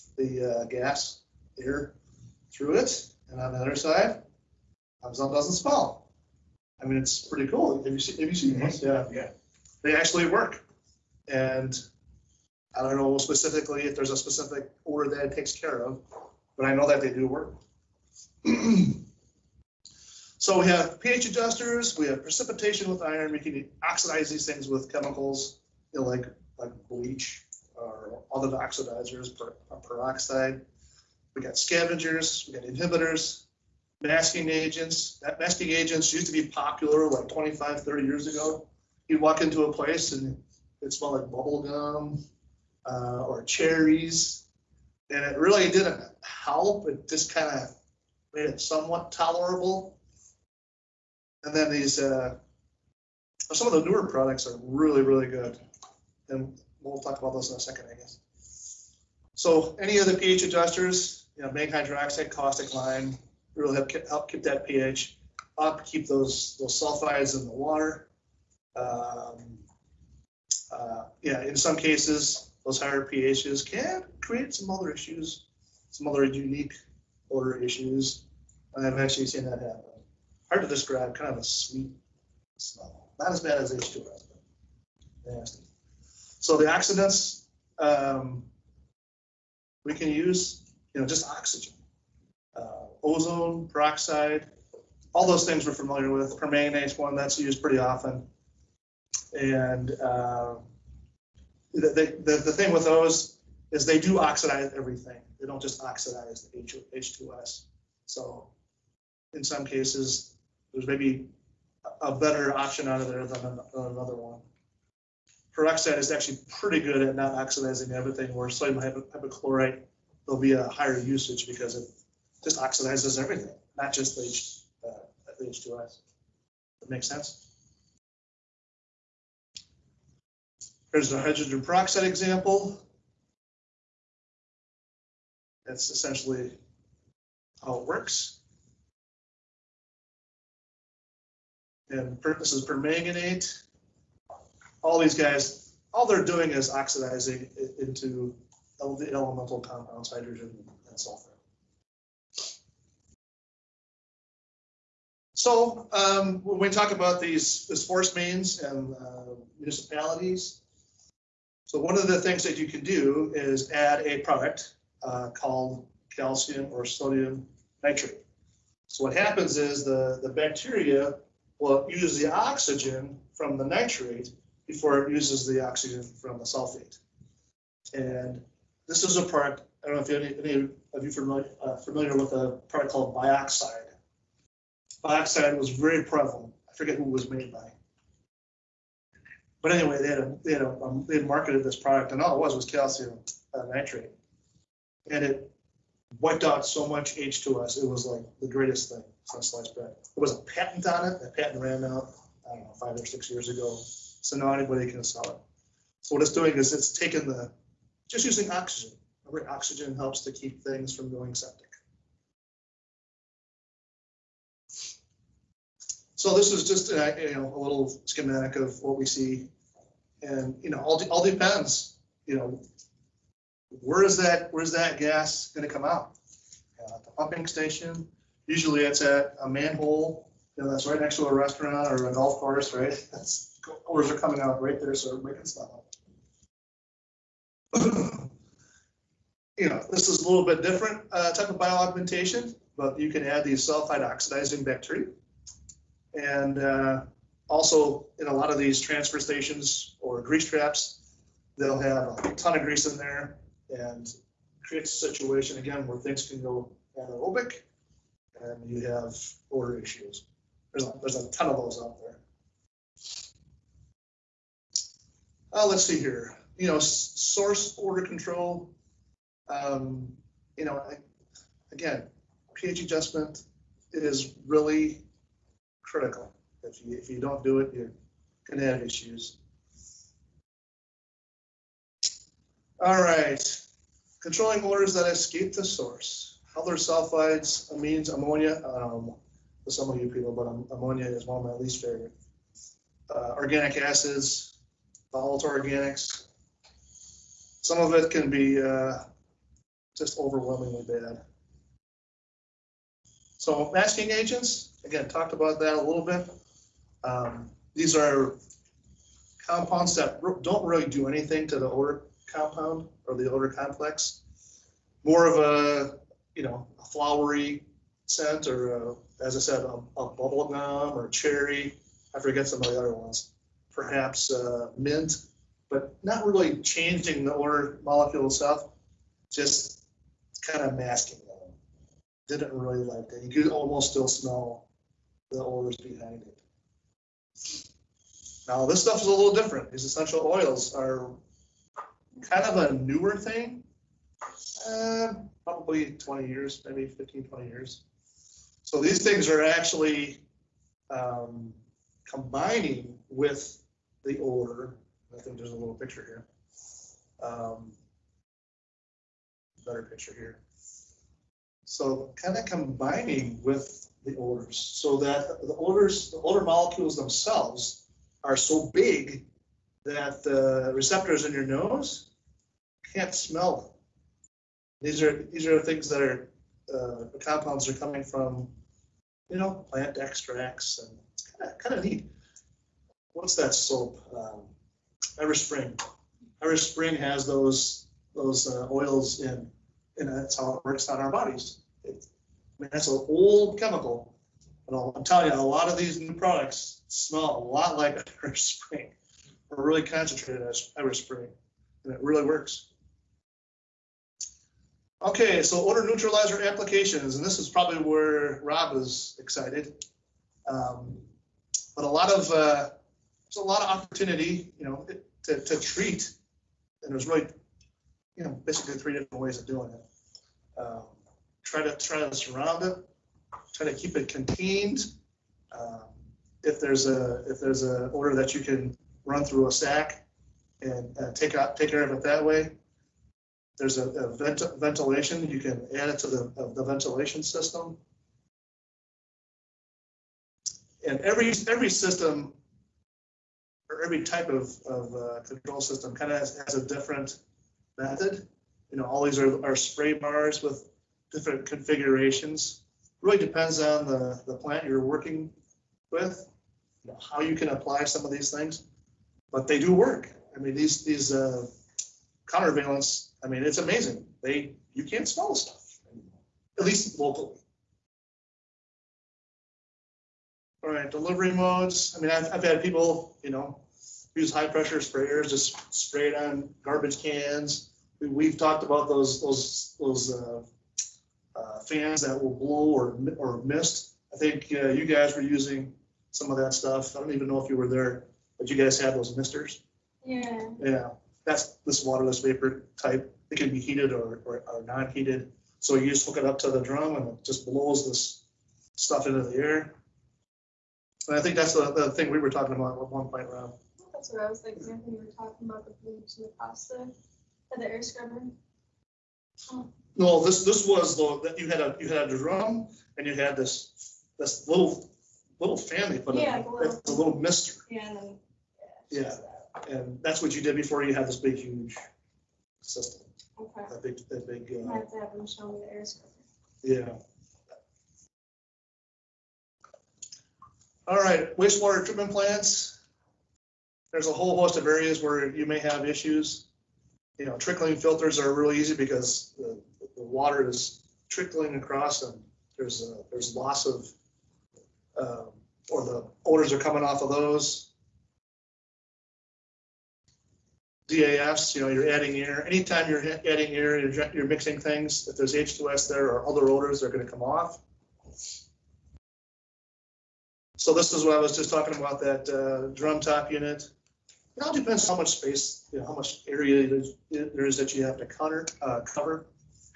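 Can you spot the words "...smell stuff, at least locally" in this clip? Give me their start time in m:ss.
7:45.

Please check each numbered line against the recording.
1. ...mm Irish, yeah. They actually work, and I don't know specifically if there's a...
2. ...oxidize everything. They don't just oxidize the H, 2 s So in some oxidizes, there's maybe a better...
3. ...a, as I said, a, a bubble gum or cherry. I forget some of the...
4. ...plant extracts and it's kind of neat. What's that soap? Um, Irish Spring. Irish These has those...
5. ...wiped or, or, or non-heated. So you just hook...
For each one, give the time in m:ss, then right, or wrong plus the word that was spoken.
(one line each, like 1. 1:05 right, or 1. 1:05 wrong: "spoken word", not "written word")
1. 0:08 wrong: "Yeah", not "Irish"
2. 1:44 wrong: "cases", not "oxidizes"
3. 5:18 right
4. 6:19 wrong: "Spring", not "These"
5. 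8:13 wrong: "heated", not "wiped".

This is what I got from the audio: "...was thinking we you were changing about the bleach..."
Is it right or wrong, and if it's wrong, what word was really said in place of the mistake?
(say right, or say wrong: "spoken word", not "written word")
wrong: "talking", not "changing".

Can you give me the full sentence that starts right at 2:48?
So what happens is the, the bacteria will use the oxygen from the nitrate before it uses the oxygen from the sulfate.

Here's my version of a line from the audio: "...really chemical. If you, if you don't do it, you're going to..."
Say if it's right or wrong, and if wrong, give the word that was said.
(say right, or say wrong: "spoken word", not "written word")
wrong: "critical", not "chemical".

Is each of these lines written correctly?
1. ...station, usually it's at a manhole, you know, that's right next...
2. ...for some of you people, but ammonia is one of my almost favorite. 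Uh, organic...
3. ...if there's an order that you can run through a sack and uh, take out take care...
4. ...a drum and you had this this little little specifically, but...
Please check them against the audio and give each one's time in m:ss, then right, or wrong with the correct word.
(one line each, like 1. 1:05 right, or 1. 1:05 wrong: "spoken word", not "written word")
1. 3:47 right
2. 4:49 wrong: "least", not "almost"
3. 7:07 right
4. 8:32 wrong: "family", not "specifically".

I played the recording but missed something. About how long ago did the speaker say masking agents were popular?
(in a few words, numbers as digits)
25 to 30 years ago.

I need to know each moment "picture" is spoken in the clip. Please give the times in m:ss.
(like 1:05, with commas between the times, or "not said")
5:55, 5:59.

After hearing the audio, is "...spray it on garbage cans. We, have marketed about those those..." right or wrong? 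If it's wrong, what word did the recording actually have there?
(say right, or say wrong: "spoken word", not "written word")
wrong: "talked", not "marketed".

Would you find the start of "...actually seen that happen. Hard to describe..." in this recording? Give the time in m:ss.
1:18.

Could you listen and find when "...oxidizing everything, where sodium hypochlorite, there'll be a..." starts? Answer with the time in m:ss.
1:57.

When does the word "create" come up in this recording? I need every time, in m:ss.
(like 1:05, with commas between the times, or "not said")
1:14, 4:14.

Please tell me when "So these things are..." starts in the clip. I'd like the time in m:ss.
5:48.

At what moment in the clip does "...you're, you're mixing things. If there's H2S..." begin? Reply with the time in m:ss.
9:13.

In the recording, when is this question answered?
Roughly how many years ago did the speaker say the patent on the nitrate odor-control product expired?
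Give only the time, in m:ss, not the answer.
3:22.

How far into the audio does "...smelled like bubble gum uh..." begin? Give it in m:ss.
0:40.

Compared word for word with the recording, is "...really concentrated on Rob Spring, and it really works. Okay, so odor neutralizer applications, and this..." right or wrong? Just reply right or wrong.
wrong.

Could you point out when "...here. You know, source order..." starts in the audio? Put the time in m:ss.
4:25.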